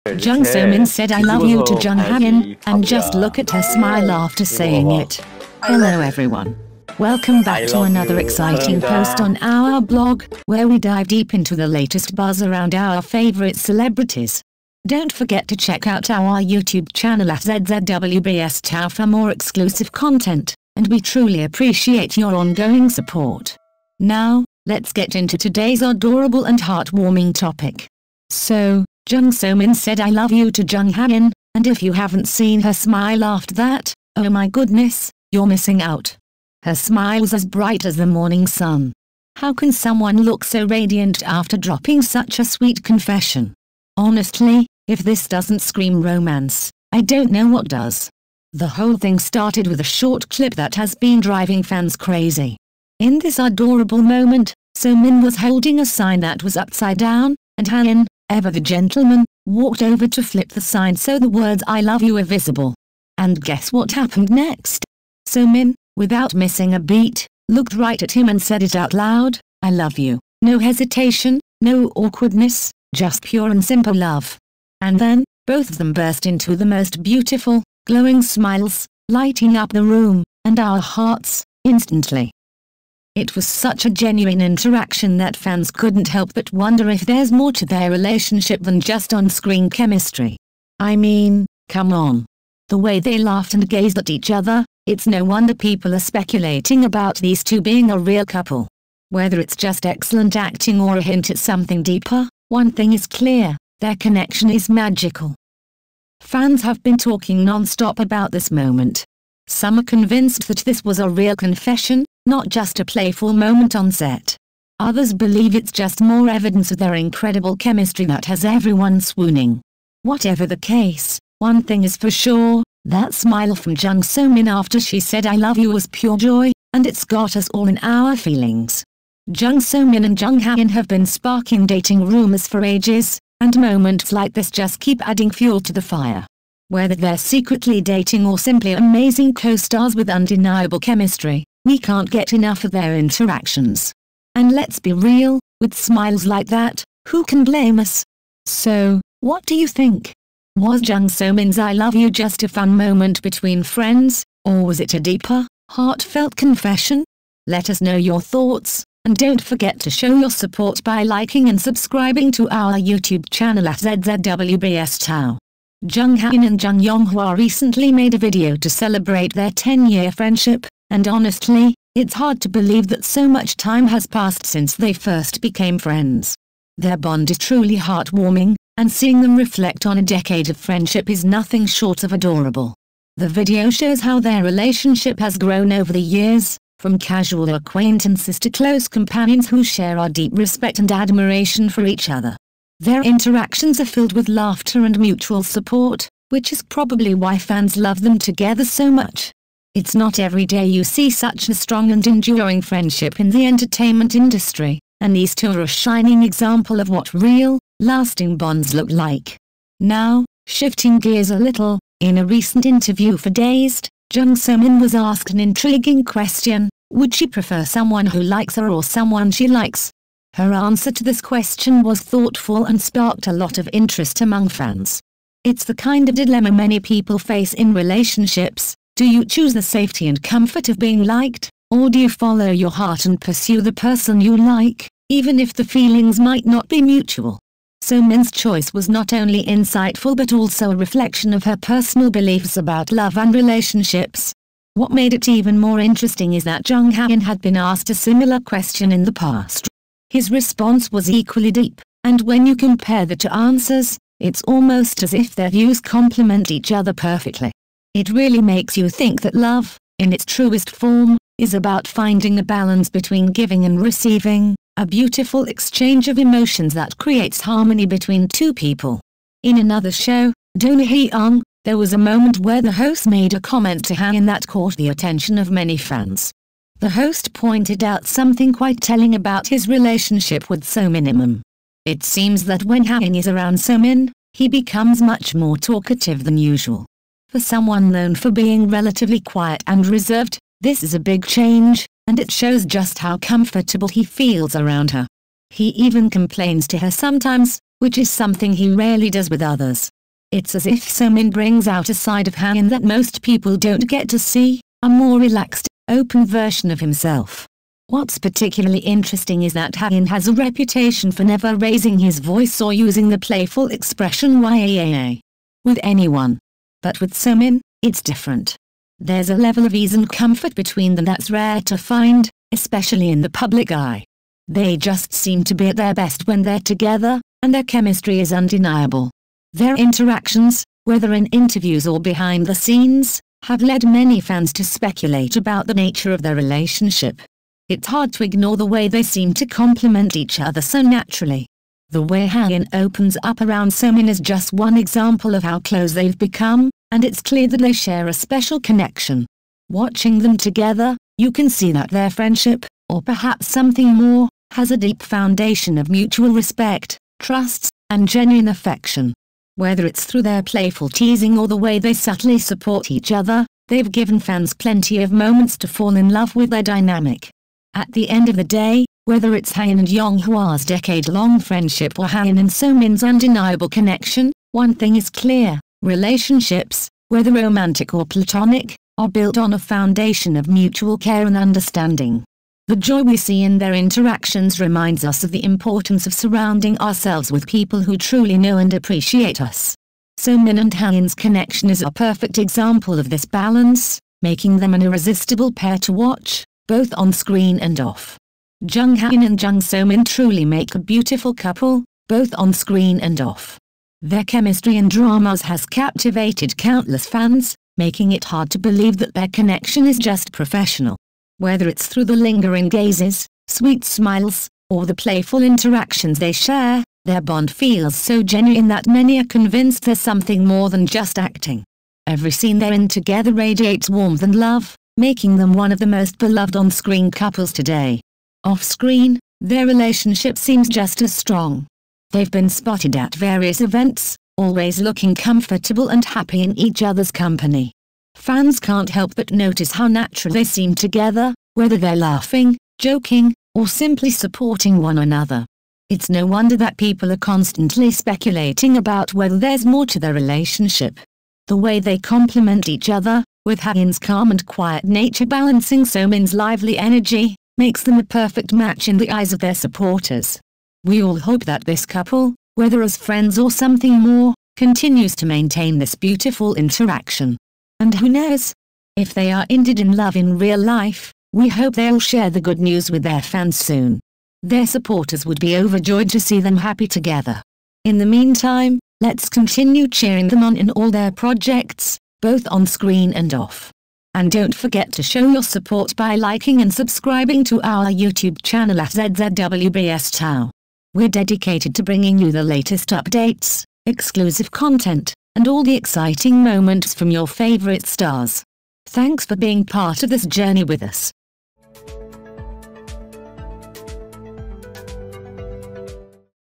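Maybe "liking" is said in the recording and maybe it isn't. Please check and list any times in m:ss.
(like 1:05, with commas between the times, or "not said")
2:41, 8:06.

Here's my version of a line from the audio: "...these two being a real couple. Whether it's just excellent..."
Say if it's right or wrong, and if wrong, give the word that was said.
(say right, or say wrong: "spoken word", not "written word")
right.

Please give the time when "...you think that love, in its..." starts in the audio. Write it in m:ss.
4:18.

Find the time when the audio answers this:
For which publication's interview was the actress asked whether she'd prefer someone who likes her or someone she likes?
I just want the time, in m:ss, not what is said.
3:33.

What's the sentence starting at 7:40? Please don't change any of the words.
We all hope that this couple, whether as friends or something more, continues to maintain this beautiful interaction.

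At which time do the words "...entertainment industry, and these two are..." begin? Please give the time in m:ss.
3:23.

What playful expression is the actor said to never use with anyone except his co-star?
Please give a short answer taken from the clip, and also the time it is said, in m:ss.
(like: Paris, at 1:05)
YAAA, at 5:14.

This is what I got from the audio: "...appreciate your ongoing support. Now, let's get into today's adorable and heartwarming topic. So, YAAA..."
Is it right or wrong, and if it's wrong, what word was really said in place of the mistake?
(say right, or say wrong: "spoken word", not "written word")
wrong: "Jung", not "YAAA".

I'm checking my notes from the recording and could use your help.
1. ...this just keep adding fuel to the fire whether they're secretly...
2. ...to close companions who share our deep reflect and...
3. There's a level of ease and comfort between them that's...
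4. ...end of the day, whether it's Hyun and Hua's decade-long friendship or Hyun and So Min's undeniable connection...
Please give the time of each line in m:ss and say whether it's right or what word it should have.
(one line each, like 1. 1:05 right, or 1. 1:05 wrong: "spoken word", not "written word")
1. 2:14 right
2. 3:08 wrong: "respect", not "reflect"
3. 5:18 right
4. 6:08 right.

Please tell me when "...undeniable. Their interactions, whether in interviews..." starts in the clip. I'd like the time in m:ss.
5:28.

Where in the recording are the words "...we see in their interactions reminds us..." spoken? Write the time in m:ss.
6:23.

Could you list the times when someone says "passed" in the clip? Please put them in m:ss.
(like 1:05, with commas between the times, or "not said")
2:54.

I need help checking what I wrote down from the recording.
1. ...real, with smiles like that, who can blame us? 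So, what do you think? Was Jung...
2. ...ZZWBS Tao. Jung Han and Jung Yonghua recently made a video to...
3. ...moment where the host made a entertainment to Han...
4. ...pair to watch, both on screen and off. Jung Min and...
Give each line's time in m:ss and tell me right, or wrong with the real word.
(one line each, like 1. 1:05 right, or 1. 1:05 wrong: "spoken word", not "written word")
1. 2:24 right
2. 2:43 right
3. 4:32 wrong: "comment", not "entertainment"
4. 6:35 wrong: "Hyun", not "Min".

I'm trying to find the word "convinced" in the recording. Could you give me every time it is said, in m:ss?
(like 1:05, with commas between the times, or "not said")
1:49, 6:59.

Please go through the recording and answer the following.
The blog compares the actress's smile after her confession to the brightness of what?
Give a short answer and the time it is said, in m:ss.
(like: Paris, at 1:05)
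The morning sun, at 0:37.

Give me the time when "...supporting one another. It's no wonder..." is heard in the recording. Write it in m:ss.
7:24.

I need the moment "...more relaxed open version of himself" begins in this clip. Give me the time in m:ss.
5:04.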